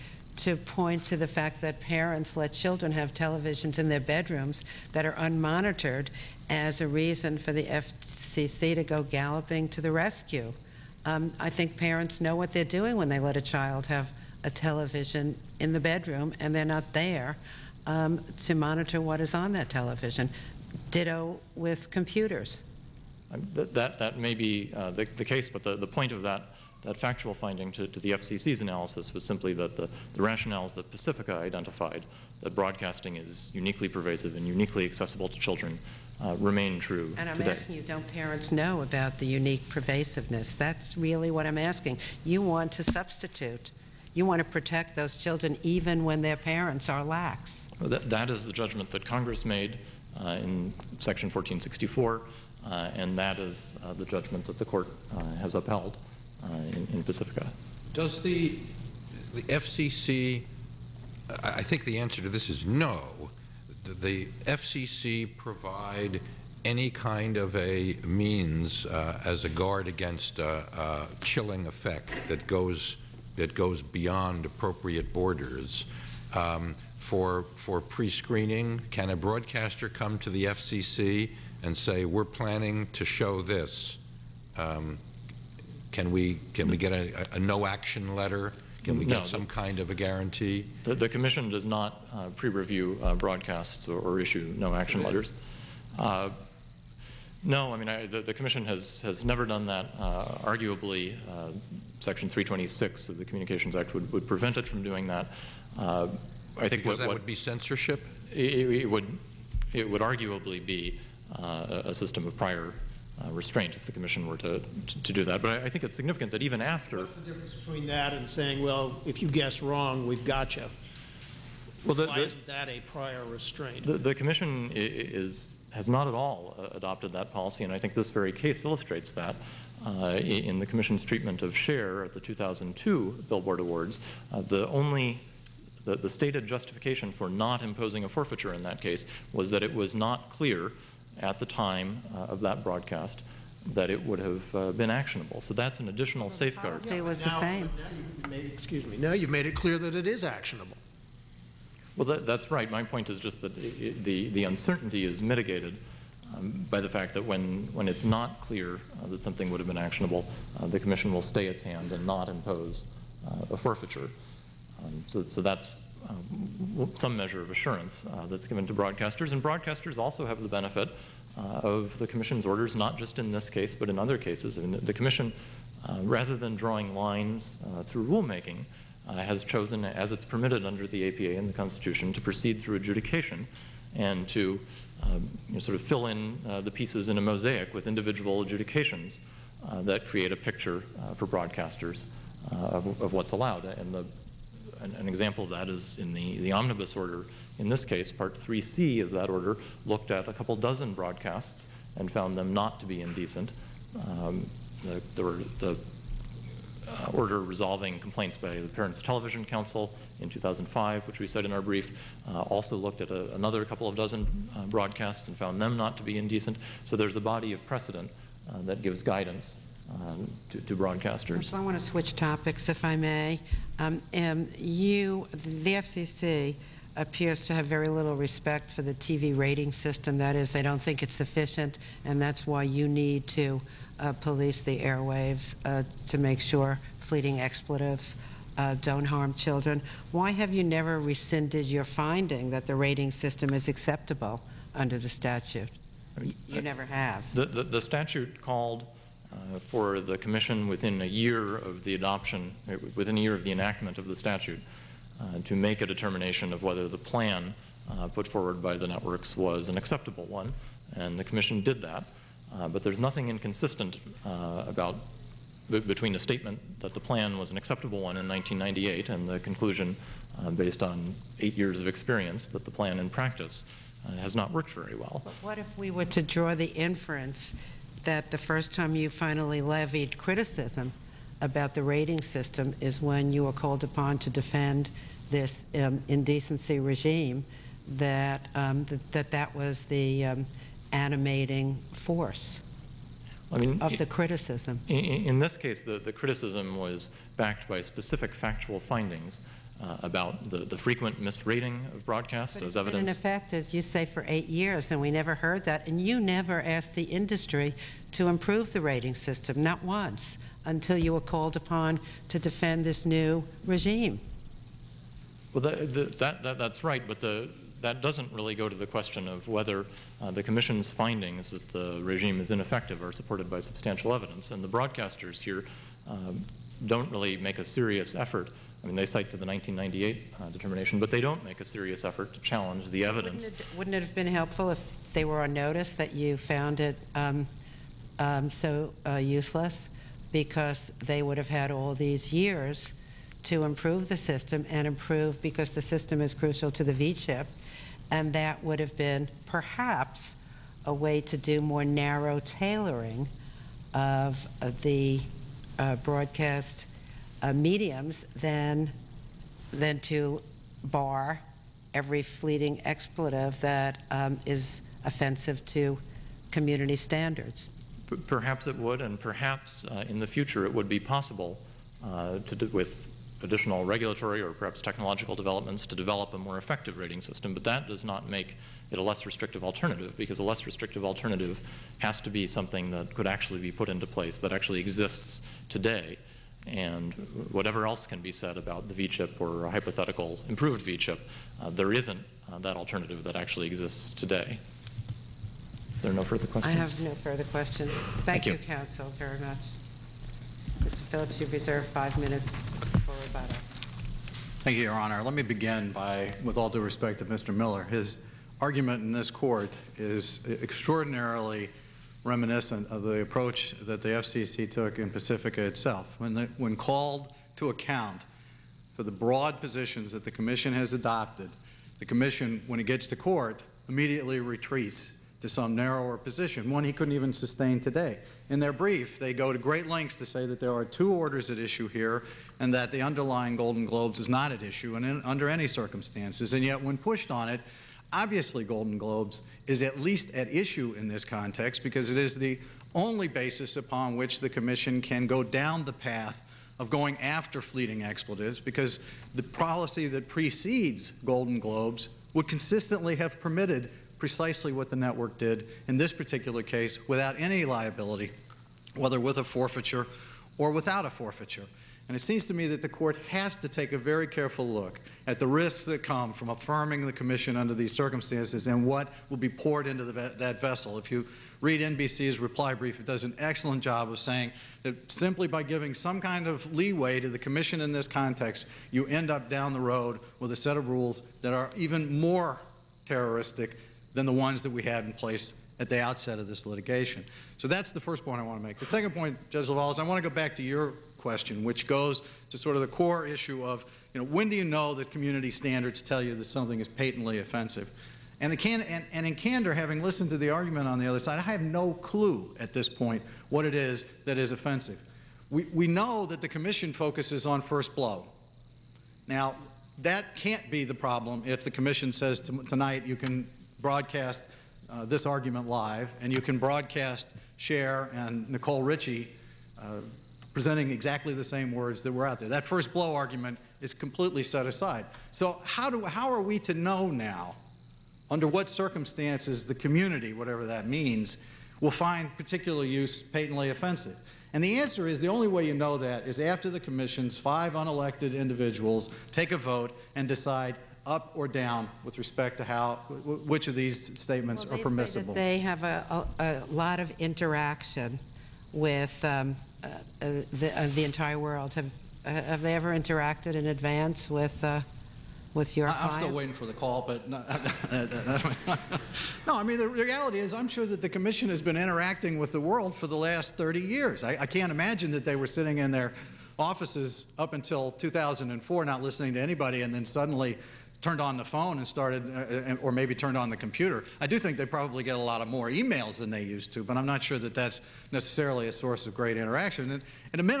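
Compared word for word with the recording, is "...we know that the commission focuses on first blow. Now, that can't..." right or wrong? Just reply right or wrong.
right.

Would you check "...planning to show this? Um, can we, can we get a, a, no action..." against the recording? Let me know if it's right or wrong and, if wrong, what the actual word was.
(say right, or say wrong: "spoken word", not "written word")
right.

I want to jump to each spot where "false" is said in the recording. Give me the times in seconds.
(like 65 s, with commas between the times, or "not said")
not said.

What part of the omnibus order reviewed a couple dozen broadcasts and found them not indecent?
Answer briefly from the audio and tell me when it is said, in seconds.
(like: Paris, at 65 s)
Part 3C, at 198 s.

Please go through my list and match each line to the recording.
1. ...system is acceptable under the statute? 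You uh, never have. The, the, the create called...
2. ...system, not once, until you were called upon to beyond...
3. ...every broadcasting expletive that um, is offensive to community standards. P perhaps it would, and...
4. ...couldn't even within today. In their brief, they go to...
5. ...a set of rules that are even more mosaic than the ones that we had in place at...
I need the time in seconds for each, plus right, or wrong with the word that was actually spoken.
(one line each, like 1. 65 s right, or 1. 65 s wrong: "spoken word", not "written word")
1. 243 s wrong: "statute", not "create"
2. 309 s wrong: "defend", not "beyond"
3. 361 s wrong: "fleeting", not "broadcasting"
4. 426 s wrong: "sustain", not "within"
5. 480 s wrong: "terroristic", not "mosaic".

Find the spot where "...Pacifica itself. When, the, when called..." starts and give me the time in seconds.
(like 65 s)
415 s.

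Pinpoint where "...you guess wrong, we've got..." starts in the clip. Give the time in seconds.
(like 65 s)
119 s.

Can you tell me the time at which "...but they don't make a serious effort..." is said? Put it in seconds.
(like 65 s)
330 s.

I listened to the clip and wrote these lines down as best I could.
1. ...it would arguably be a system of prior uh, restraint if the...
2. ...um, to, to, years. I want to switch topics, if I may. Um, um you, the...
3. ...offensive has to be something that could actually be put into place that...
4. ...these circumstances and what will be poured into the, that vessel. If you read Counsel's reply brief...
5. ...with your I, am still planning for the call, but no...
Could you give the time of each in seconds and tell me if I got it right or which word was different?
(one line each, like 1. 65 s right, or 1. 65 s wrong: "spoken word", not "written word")
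1. 109 s right
2. 219 s wrong: "broadcasters", not "years"
3. 381 s wrong: "alternative", not "offensive"
4. 467 s wrong: "NBC", not "Counsel"
5. 555 s wrong: "waiting", not "planning".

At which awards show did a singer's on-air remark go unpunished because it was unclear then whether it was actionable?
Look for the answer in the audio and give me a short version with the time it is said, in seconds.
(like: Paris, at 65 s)
2002 Billboard Awards, at 132 s.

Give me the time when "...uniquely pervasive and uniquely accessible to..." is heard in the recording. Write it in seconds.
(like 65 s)
33 s.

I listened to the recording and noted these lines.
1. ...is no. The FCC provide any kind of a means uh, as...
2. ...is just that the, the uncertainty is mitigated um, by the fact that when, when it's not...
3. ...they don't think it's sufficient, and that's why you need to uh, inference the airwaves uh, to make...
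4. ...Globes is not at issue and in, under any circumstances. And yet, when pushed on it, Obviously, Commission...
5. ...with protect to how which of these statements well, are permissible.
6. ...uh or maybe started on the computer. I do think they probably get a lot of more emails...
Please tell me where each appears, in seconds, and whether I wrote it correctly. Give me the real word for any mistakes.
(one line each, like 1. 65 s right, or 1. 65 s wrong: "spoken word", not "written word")
1. 62 s right
2. 153 s right
3. 230 s wrong: "police", not "inference"
4. 433 s wrong: "Golden", not "Commission"
5. 542 s wrong: "respect", not "protect"
6. 572 s wrong: "turned", not "started".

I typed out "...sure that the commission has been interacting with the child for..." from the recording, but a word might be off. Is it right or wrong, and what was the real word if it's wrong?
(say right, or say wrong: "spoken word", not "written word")
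wrong: "world", not "child".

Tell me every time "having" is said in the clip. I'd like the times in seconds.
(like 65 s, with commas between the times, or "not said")
499 s.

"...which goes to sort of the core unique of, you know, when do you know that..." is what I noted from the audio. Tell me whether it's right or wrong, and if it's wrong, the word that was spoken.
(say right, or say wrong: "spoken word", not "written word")
wrong: "issue", not "unique".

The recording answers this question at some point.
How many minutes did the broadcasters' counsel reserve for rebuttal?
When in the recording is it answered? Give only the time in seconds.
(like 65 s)
401 s.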